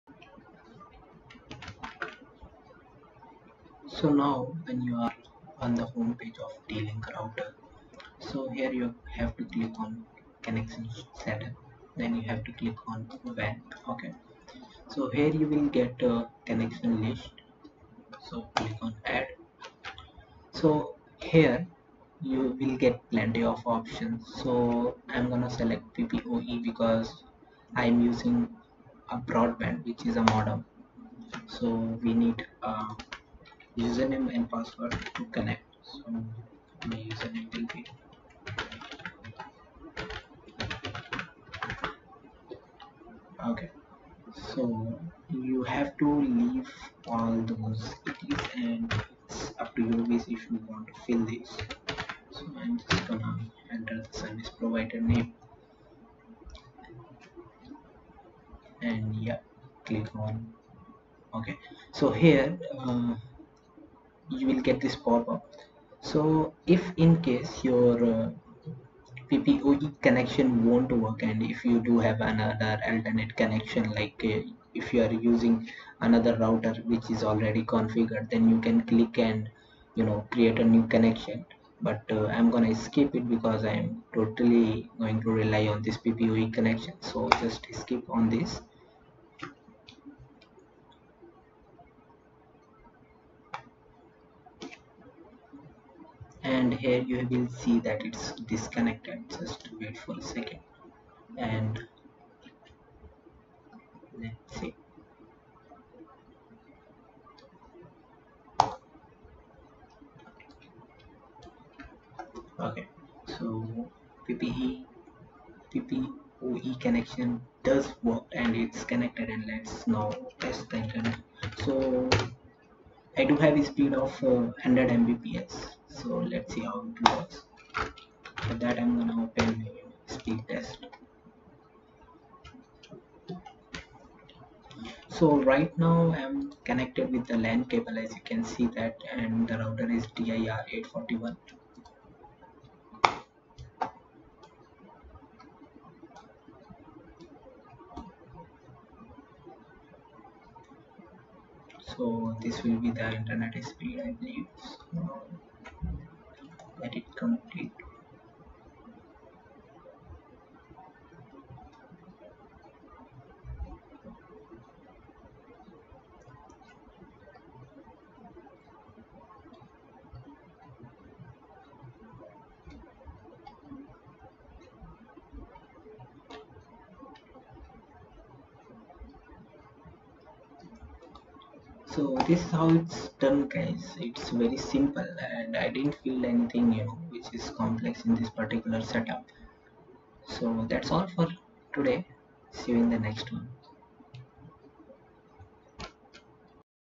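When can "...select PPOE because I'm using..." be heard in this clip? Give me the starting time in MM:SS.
00:25.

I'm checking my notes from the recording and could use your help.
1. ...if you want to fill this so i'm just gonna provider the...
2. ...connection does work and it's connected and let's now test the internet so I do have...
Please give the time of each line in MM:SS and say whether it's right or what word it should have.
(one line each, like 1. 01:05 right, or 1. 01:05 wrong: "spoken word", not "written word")
1. 00:50 wrong: "enter", not "provider"
2. 01:56 right.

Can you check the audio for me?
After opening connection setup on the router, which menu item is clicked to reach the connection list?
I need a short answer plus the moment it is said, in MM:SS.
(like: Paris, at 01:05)
WAN, at 00:13.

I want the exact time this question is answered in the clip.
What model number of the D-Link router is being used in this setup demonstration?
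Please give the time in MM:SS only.
02:20.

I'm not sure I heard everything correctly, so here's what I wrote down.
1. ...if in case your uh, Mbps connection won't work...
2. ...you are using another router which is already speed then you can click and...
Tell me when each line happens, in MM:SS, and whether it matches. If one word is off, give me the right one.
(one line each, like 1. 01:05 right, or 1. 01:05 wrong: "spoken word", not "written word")
1. 01:06 wrong: "PPOE", not "Mbps"
2. 01:14 wrong: "configured", not "speed".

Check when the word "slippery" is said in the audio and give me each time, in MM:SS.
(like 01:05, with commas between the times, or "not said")
not said.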